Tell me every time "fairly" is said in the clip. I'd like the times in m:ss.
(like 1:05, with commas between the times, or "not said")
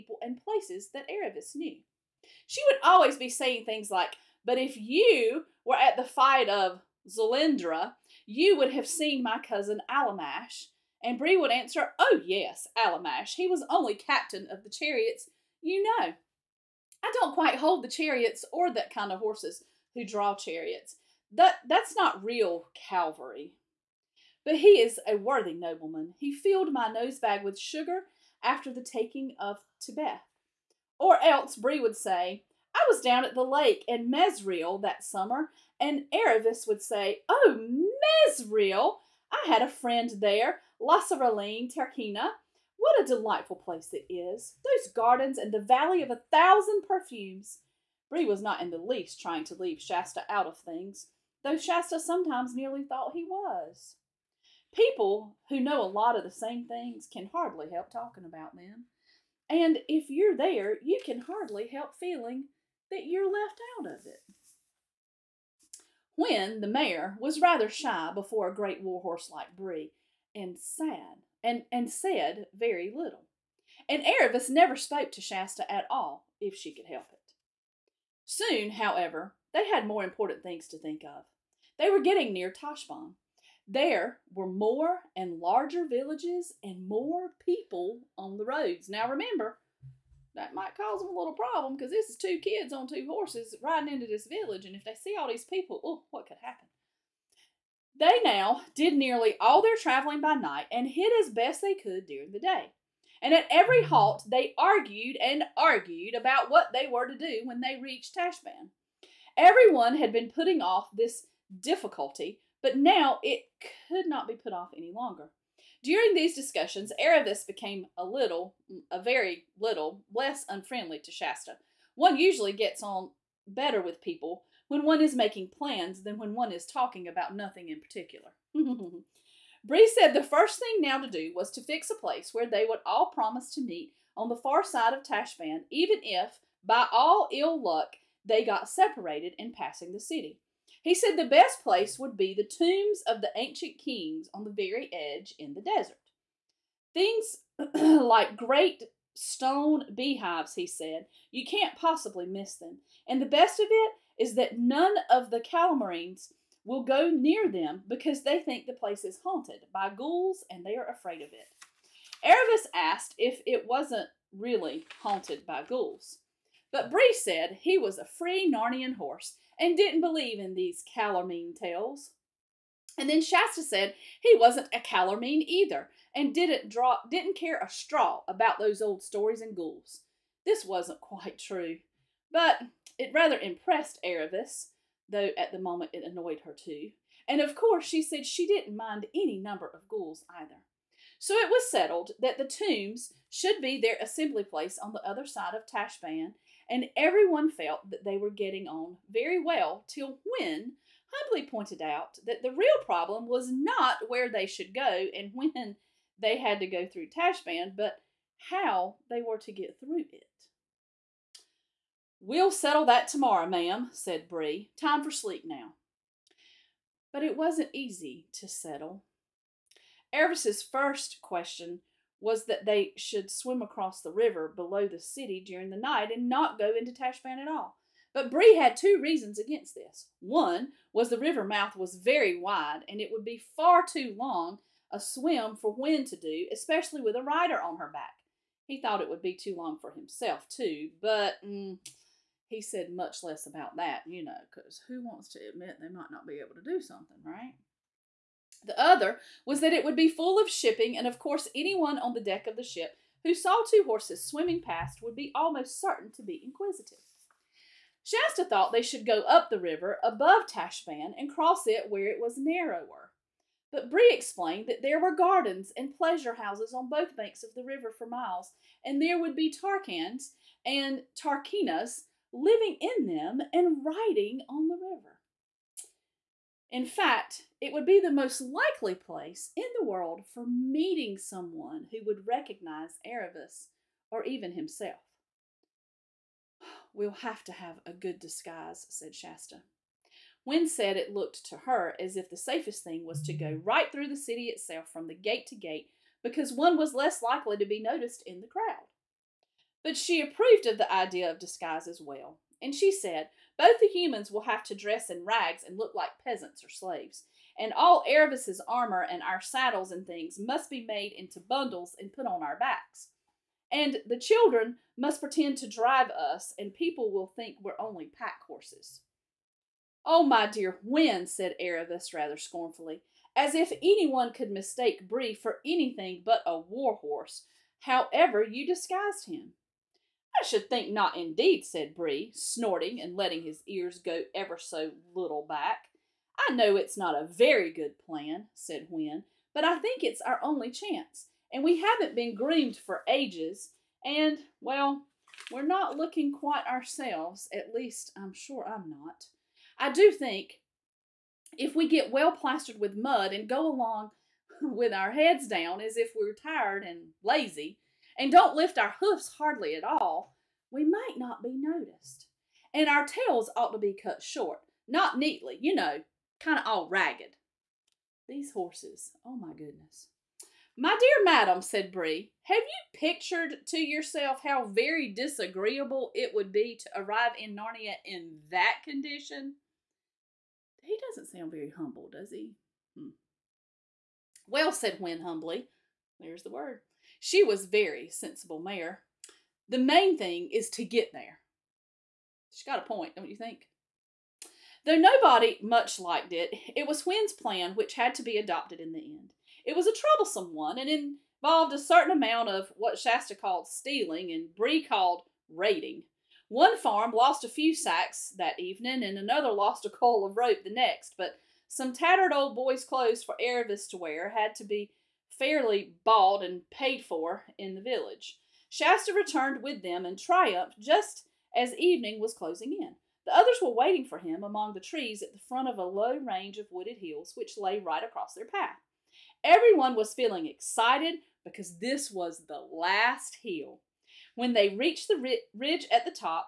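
6:55.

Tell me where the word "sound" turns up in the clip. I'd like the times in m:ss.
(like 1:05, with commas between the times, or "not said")
6:21.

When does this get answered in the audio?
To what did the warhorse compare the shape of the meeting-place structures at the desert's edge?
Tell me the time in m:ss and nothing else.
2:28.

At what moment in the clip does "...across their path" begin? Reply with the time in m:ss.
7:08.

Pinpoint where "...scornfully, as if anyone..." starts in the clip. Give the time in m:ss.
5:22.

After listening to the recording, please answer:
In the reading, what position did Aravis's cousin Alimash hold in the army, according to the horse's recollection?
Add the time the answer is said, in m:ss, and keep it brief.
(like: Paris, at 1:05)
Captain of the chariots, at 0:13.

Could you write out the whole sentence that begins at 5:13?
And the children must pretend to drive us, and people will think we're only pack horses.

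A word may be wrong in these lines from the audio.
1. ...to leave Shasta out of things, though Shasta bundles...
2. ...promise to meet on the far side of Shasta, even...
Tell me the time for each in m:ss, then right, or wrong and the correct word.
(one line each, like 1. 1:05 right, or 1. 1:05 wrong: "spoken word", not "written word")
1. 0:49 wrong: "sometimes", not "bundles"
2. 2:13 wrong: "Tashban", not "Shasta".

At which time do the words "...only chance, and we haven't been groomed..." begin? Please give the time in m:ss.
5:40.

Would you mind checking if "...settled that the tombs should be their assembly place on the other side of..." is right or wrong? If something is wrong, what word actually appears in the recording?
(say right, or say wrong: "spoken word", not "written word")
right.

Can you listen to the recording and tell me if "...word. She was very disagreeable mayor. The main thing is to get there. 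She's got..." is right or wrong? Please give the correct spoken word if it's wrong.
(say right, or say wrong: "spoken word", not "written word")
wrong: "sensible", not "disagreeable".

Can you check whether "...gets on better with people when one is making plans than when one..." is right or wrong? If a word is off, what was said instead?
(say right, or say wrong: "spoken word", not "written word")
right.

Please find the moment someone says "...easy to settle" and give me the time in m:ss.
3:37.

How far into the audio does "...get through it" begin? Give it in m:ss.
3:29.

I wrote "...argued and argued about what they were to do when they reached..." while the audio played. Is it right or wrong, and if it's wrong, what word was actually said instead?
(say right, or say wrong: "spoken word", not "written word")
right.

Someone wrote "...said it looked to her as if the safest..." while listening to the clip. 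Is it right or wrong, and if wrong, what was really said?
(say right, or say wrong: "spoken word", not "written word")
right.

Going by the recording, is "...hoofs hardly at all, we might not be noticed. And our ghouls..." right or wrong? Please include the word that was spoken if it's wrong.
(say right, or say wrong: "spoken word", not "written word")
wrong: "tails", not "ghouls".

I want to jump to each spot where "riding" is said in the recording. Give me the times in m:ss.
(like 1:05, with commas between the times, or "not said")
1:33, 4:33.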